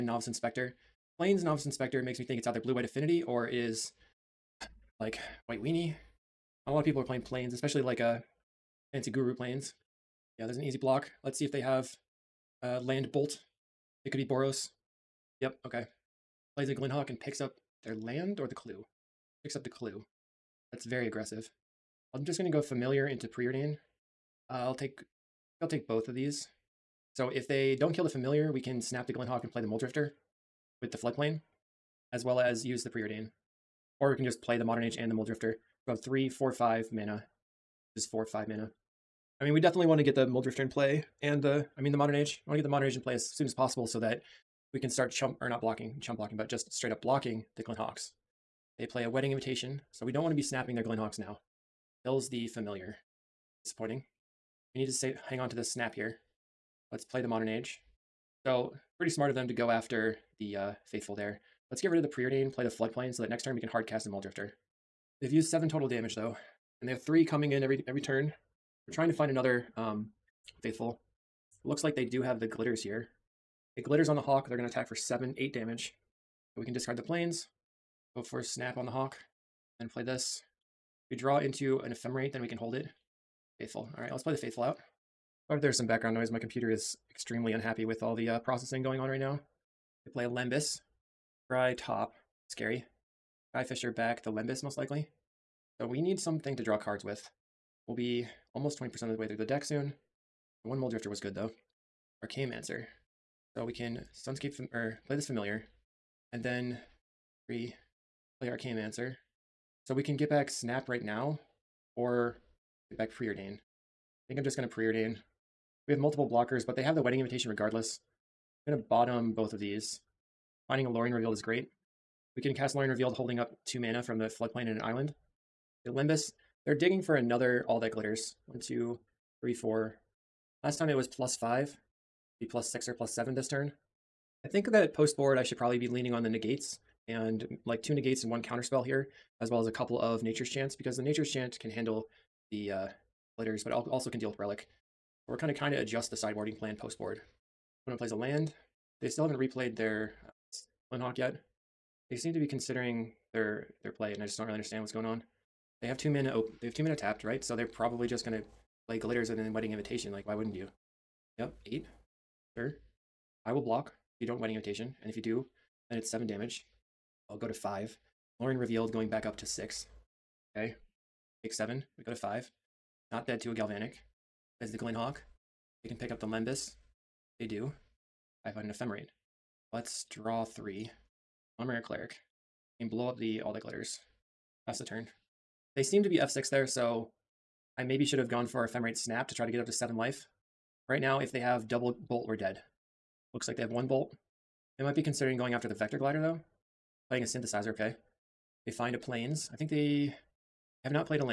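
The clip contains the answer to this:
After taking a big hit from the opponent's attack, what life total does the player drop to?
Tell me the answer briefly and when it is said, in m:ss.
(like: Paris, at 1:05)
5, at 2:51.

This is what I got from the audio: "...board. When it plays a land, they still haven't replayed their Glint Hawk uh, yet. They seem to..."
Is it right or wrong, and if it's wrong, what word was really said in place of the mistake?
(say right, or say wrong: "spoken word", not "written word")
right.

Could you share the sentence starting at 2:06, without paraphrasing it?
They're digging for another all that glitters.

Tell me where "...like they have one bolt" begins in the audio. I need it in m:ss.
3:13.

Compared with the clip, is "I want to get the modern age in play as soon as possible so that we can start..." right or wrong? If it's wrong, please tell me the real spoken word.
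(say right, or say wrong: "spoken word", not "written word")
right.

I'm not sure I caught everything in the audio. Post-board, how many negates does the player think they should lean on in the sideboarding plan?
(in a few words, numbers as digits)
2.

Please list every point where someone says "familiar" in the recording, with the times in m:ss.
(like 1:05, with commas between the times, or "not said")
0:22, 0:28, 0:52, 1:45.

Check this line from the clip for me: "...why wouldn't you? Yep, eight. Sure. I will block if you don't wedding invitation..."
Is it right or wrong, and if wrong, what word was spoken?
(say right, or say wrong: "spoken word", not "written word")
right.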